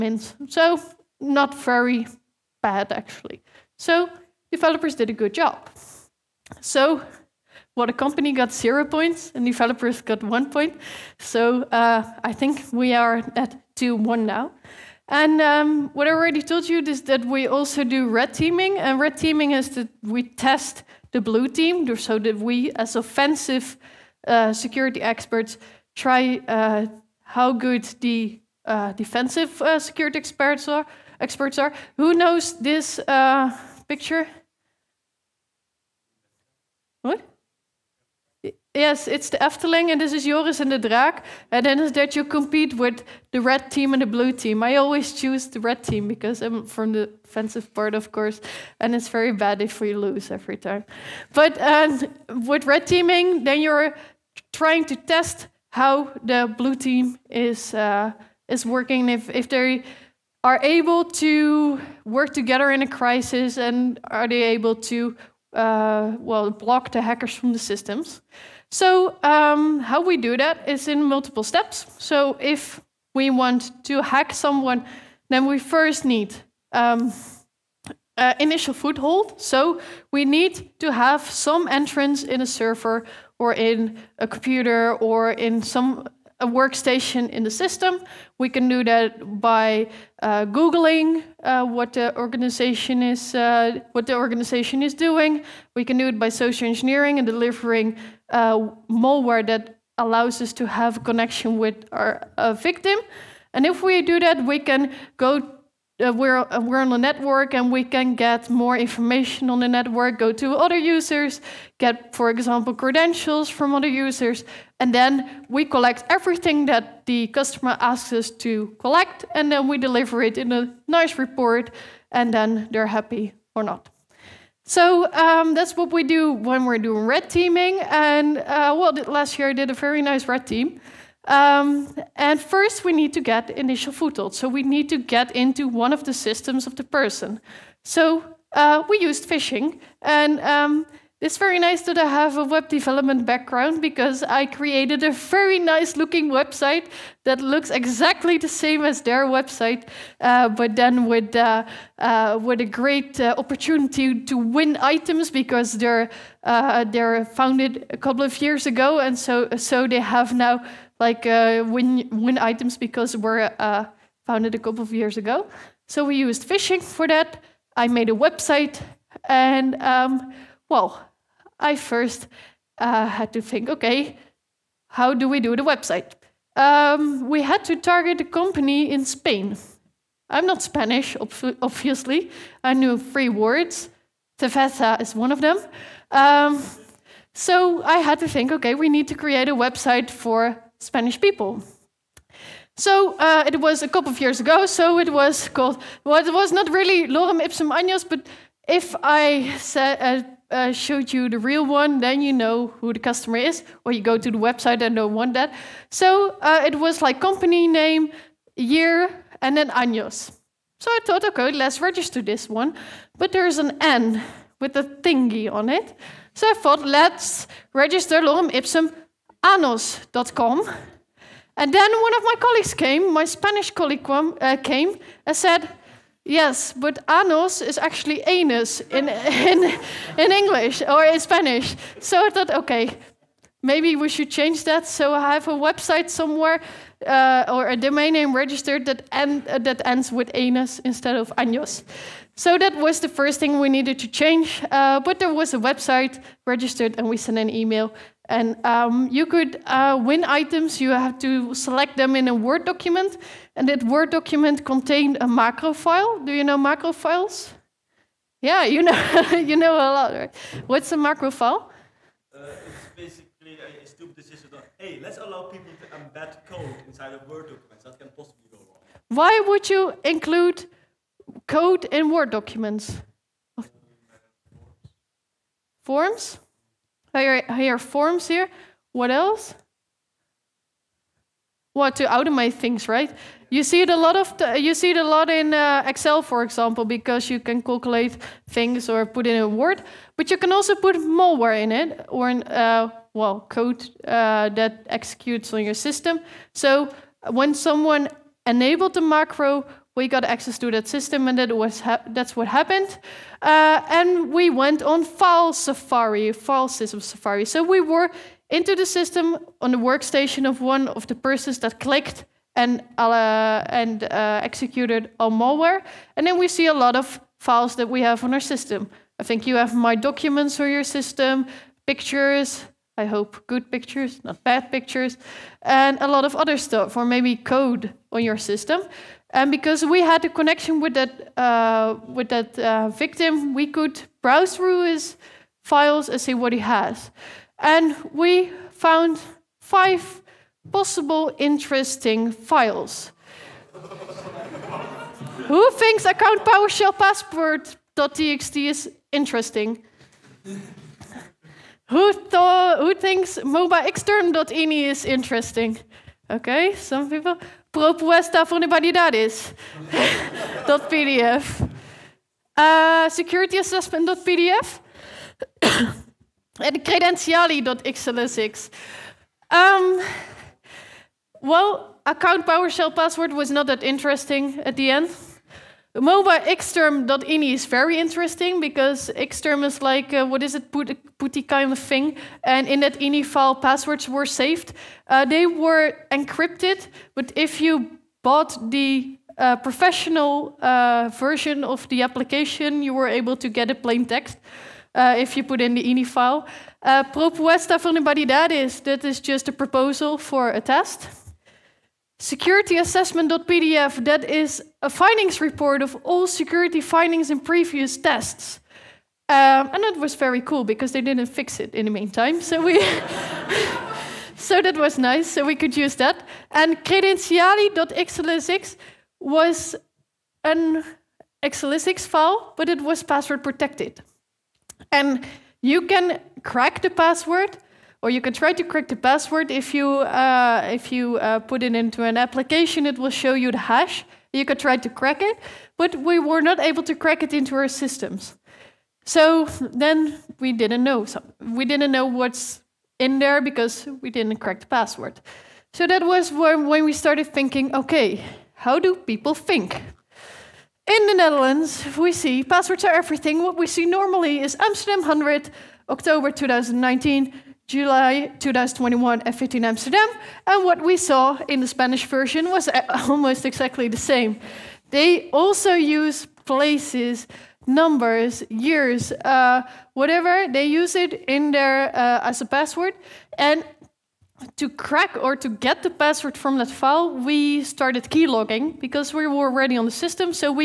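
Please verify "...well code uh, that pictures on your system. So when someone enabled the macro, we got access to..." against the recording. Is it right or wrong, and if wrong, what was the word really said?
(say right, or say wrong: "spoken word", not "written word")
wrong: "executes", not "pictures".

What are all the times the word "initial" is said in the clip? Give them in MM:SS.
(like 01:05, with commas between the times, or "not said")
01:18, 02:13.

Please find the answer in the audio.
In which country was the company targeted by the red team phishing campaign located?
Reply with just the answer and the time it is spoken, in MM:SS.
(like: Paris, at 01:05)
Spain, at 02:59.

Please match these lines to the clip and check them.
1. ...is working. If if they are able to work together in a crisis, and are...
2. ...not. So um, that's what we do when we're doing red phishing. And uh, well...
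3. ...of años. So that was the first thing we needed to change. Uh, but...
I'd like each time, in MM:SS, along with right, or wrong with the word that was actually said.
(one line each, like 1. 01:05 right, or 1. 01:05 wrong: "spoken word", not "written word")
1. 00:58 right
2. 02:03 wrong: "teaming", not "phishing"
3. 04:01 right.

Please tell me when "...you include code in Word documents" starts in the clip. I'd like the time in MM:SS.
04:29.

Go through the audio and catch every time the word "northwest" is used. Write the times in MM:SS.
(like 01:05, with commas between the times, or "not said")
not said.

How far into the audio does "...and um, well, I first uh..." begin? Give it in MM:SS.
02:49.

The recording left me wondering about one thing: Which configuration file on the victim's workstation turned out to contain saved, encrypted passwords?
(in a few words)
MobaXterm.ini.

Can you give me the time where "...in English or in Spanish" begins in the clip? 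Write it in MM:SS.
03:50.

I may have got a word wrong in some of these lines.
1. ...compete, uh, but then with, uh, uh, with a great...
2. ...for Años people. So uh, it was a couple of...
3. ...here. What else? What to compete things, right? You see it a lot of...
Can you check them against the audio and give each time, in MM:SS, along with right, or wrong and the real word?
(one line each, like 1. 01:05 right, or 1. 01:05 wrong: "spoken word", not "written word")
1. 02:29 wrong: "website", not "compete"
2. 03:10 wrong: "Spanish", not "Años"
3. 04:38 wrong: "automate", not "compete".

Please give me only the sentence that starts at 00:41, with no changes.
And then is that you compete with the red team and the blue team.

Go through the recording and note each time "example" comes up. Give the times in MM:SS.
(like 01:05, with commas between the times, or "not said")
01:52, 04:46.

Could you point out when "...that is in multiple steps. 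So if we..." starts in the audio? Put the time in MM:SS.
01:10.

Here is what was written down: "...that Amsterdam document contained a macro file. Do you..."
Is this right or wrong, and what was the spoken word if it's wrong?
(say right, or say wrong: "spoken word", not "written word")
wrong: "Word", not "Amsterdam".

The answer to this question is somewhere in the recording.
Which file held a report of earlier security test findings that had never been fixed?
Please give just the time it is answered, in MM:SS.
06:42.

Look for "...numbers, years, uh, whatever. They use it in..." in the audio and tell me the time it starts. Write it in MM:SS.
07:47.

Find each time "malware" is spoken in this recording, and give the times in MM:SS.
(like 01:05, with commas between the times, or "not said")
01:38, 04:50, 05:15.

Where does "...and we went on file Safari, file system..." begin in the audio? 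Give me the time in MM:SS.
05:03.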